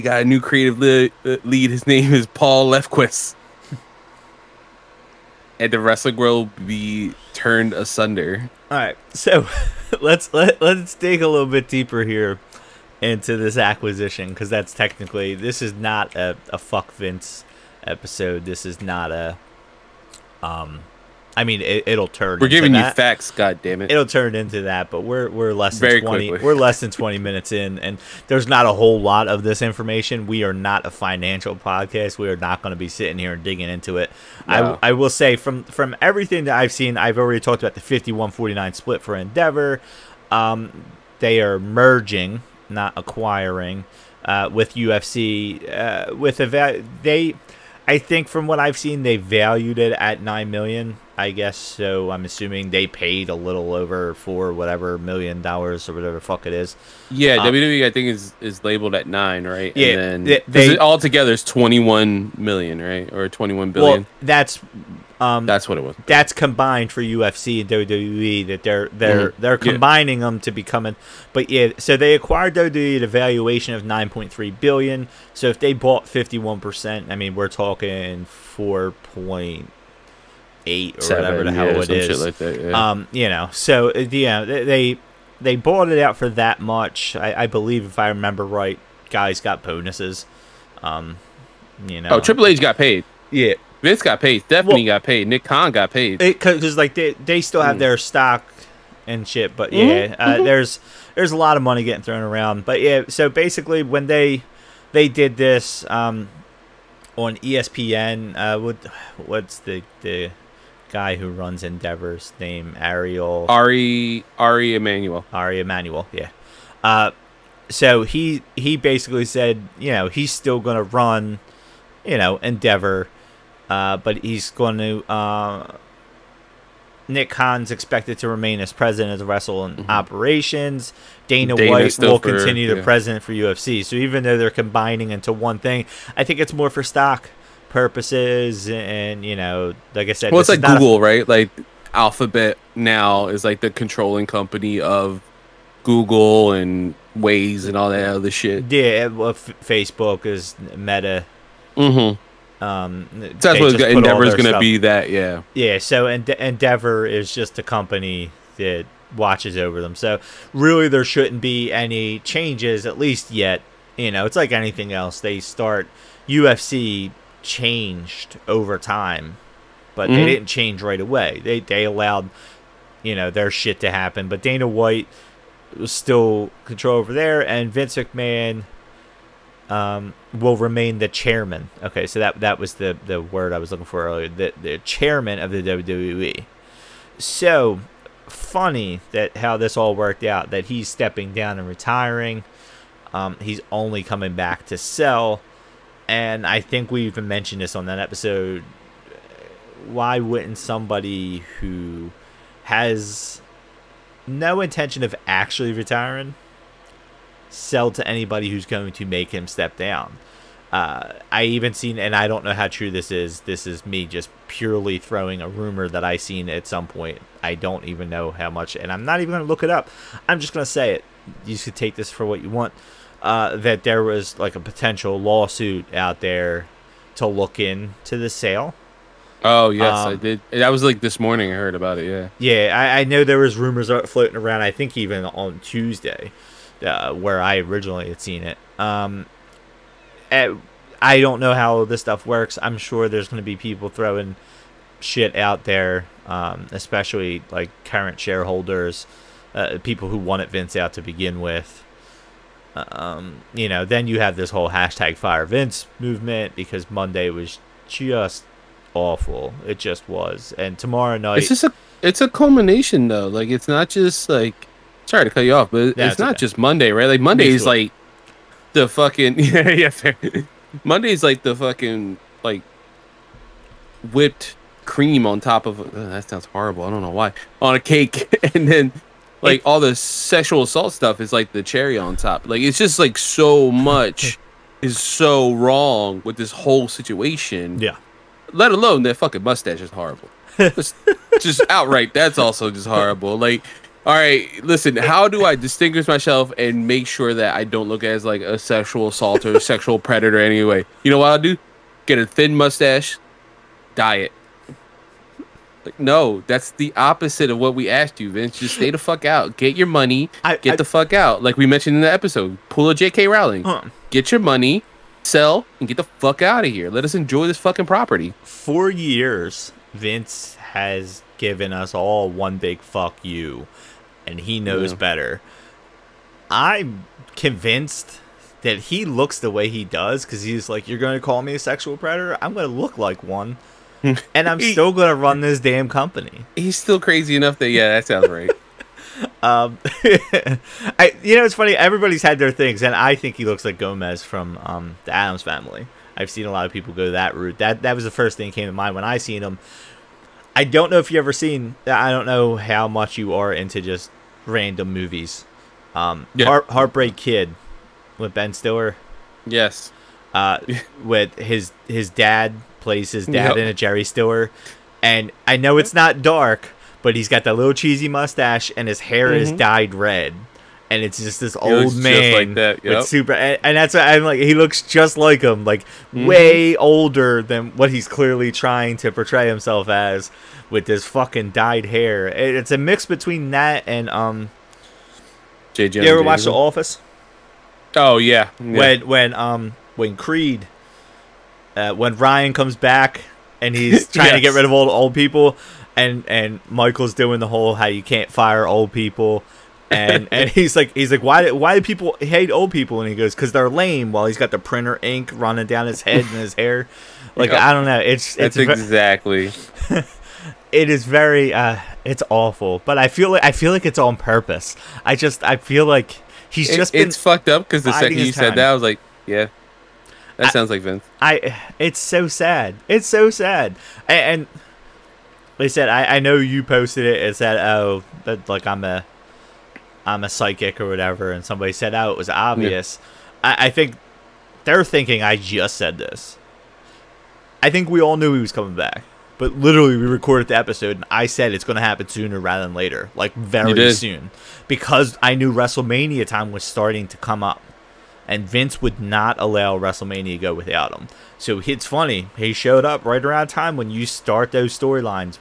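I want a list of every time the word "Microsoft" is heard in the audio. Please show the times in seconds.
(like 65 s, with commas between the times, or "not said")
not said.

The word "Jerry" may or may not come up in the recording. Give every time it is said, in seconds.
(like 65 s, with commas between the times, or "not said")
363 s.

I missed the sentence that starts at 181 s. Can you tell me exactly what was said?
Okay, so that that was the the word I was looking for earlier.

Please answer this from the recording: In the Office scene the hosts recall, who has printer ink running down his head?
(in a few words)
Creed.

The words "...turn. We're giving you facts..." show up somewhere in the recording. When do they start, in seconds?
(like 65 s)
22 s.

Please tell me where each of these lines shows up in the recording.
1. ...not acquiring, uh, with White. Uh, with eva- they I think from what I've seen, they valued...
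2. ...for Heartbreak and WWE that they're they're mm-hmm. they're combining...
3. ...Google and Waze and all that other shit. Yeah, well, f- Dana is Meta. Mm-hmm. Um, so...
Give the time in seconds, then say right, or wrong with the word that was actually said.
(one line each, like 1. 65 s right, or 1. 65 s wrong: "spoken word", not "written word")
1. 42 s wrong: "UFC", not "White"
2. 66 s wrong: "UFC", not "Heartbreak"
3. 145 s wrong: "Facebook", not "Dana".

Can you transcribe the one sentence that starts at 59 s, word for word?
Yeah, and then, they, they all together is 21 million, right, or 21 billion.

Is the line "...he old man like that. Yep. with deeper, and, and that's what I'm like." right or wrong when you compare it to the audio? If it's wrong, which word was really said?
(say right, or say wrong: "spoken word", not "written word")
wrong: "super", not "deeper".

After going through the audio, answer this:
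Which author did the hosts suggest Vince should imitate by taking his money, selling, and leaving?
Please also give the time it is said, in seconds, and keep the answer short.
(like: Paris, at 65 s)
J.K. Rowling, at 312 s.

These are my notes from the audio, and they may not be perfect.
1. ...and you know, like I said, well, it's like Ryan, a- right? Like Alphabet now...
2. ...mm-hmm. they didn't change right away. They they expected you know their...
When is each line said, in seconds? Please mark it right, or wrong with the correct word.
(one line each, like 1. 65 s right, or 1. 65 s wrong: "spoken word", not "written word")
1. 138 s wrong: "Google", not "Ryan"
2. 170 s wrong: "allowed", not "expected".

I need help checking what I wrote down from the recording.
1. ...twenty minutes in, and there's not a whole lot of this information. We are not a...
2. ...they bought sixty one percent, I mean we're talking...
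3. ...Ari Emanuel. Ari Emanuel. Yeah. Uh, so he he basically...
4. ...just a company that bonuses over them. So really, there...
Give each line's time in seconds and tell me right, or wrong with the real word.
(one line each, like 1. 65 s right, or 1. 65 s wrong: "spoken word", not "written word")
1. 26 s right
2. 75 s wrong: "fifty", not "sixty"
3. 114 s right
4. 157 s wrong: "watches", not "bonuses".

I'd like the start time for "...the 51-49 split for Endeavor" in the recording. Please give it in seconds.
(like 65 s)
37 s.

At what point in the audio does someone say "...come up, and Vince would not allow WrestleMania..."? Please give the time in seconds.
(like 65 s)
447 s.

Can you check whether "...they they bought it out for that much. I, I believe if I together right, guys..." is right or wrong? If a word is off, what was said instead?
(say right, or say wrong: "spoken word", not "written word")
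wrong: "remember", not "together".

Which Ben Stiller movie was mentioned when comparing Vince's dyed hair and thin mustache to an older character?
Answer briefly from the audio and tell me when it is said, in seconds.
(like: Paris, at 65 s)
Heartbreak Kid, at 356 s.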